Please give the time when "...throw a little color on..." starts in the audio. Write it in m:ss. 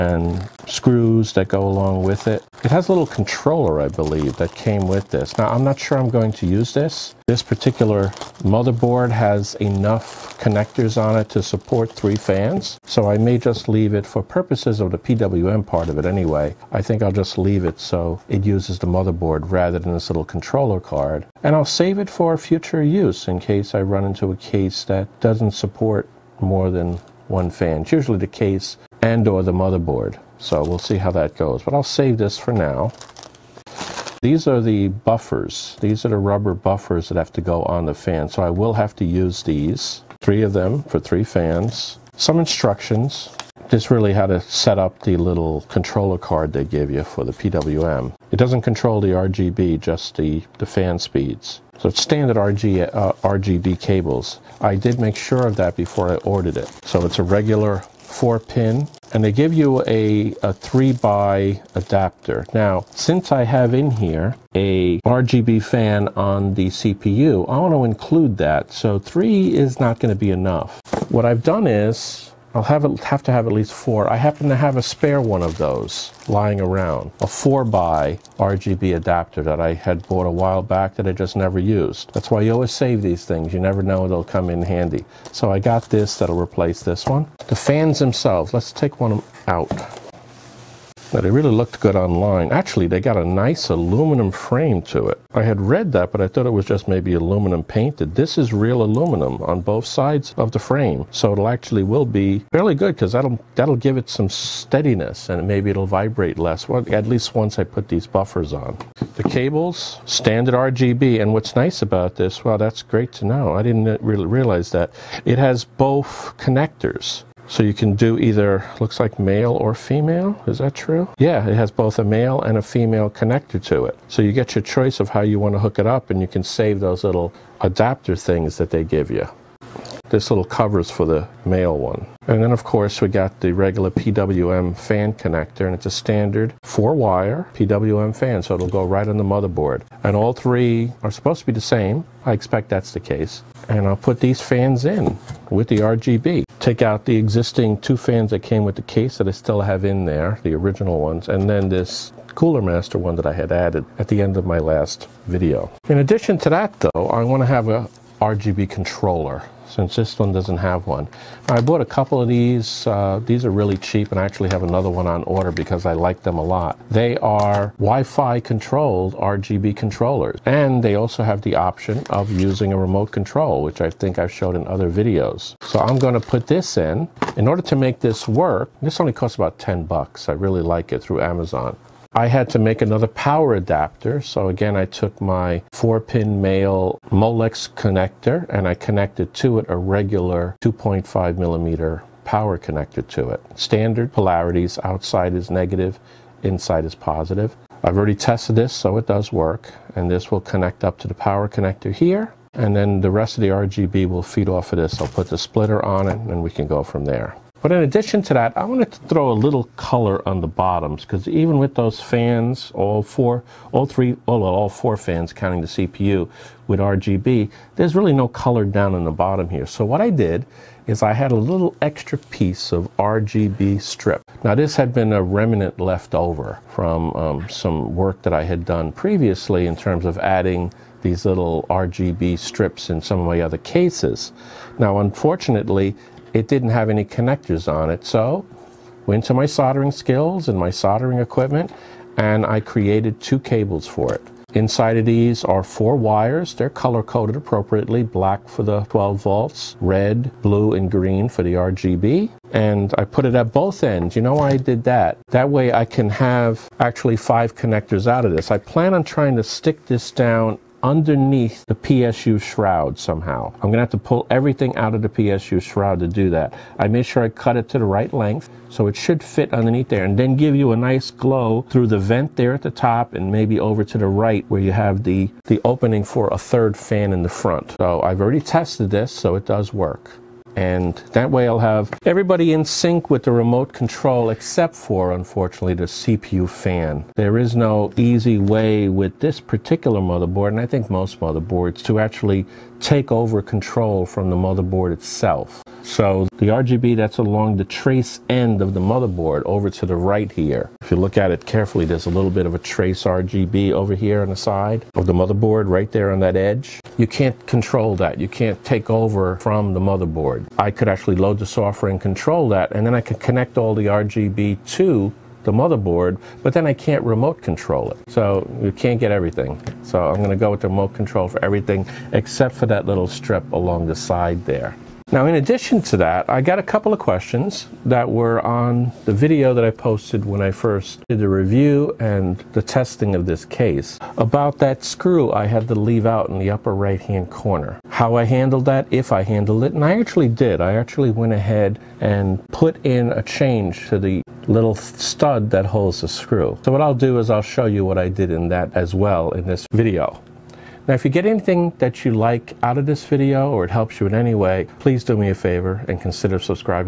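3:29.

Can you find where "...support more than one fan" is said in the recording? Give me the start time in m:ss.
0:25.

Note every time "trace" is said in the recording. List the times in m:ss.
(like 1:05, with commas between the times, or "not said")
4:57, 5:02.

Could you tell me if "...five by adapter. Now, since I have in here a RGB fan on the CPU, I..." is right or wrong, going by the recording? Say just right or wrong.
wrong.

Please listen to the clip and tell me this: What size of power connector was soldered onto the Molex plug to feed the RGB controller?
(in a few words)
2.5 millimeter.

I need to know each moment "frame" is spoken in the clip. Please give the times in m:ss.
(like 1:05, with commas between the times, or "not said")
1:34, 1:40.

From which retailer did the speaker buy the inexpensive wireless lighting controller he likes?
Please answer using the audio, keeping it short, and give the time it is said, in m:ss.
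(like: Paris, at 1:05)
Amazon, at 3:01.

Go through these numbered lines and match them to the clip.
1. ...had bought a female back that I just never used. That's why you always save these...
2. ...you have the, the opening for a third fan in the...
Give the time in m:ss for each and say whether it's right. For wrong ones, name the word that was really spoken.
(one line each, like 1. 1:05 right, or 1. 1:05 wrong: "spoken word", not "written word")
1. 1:19 wrong: "while", not "female"
2. 4:34 right.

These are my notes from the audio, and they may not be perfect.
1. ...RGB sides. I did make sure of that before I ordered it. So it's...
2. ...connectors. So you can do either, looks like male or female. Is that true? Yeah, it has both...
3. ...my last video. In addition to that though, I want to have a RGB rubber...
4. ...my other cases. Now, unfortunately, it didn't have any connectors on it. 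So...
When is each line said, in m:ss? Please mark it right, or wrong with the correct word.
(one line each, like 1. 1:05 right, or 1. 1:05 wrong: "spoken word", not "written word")
1. 0:53 wrong: "cables", not "sides"
2. 1:56 right
3. 2:34 wrong: "controller", not "rubber"
4. 3:53 right.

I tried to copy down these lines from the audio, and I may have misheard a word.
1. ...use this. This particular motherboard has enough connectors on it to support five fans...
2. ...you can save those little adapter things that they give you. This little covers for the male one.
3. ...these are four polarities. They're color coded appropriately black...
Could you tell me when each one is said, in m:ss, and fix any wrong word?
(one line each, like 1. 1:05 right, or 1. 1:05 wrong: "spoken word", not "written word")
1. 0:06 wrong: "three", not "five"
2. 2:06 right
3. 4:05 wrong: "wires", not "polarities".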